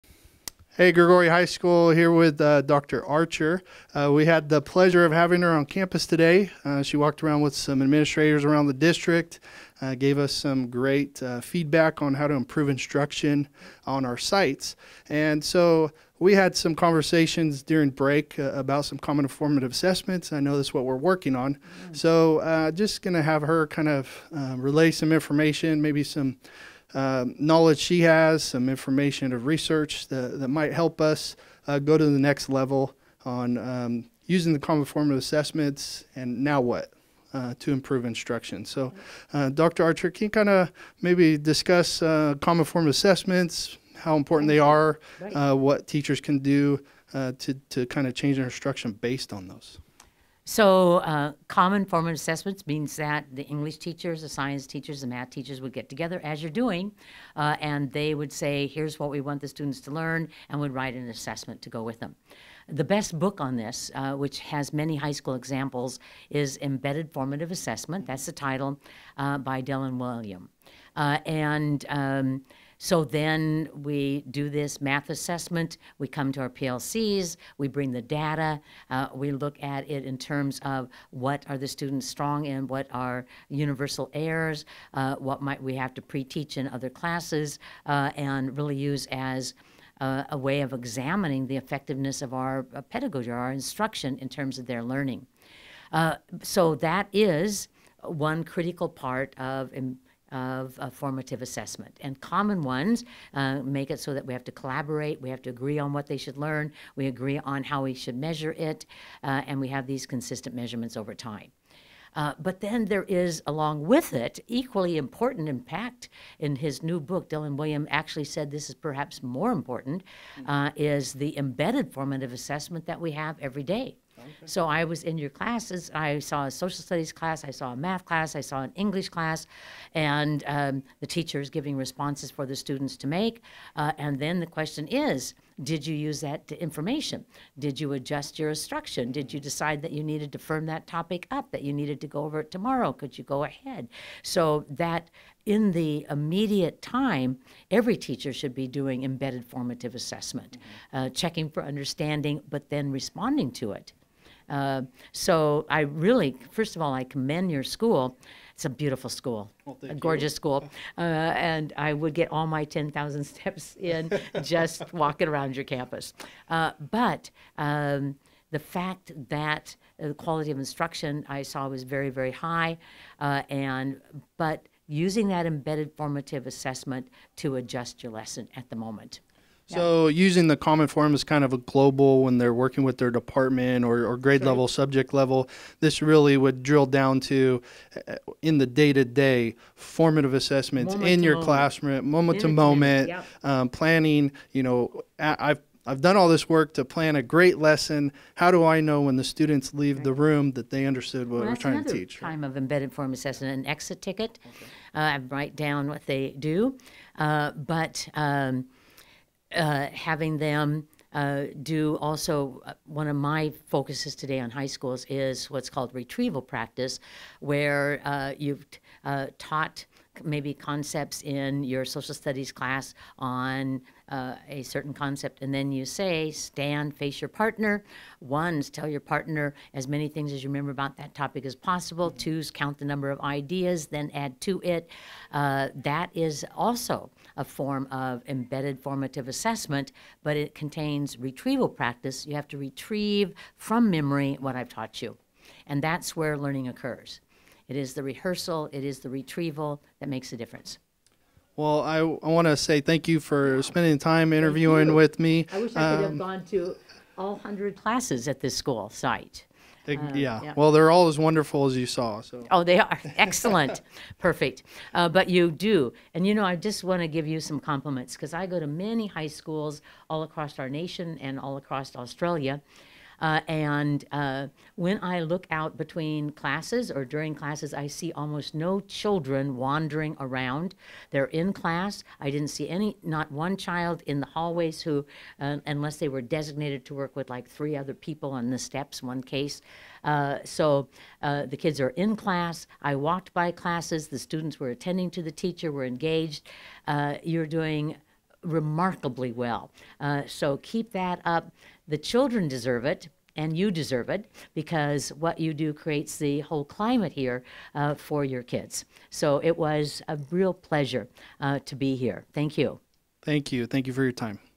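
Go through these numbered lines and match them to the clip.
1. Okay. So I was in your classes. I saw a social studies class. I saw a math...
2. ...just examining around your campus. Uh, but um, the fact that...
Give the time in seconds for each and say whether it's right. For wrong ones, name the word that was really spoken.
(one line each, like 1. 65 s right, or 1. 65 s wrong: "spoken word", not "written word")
1. 124 s right
2. 164 s wrong: "walking", not "examining".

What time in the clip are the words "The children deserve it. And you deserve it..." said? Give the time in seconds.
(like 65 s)
301 s.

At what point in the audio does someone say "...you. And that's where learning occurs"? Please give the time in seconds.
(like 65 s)
245 s.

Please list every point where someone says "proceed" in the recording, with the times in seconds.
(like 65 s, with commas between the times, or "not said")
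not said.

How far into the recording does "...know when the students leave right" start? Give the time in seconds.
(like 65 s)
198 s.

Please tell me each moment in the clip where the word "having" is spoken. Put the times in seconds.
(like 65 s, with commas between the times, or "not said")
5 s, 209 s.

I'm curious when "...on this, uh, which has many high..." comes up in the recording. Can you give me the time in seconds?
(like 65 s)
63 s.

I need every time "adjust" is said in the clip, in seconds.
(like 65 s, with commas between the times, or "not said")
137 s, 177 s.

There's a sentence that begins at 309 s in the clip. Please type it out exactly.
So it was a real pleasure uh, to be here.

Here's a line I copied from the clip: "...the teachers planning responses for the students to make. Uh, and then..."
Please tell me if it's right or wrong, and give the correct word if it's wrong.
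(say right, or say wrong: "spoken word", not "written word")
wrong: "giving", not "planning".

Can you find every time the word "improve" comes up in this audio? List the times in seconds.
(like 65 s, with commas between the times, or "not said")
12 s, 37 s.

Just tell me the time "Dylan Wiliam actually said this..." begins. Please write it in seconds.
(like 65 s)
117 s.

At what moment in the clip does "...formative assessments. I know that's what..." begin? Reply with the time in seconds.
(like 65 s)
19 s.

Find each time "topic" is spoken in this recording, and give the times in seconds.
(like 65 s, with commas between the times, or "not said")
140 s, 231 s.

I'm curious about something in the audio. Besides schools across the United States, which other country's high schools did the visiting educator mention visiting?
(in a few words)
Australia.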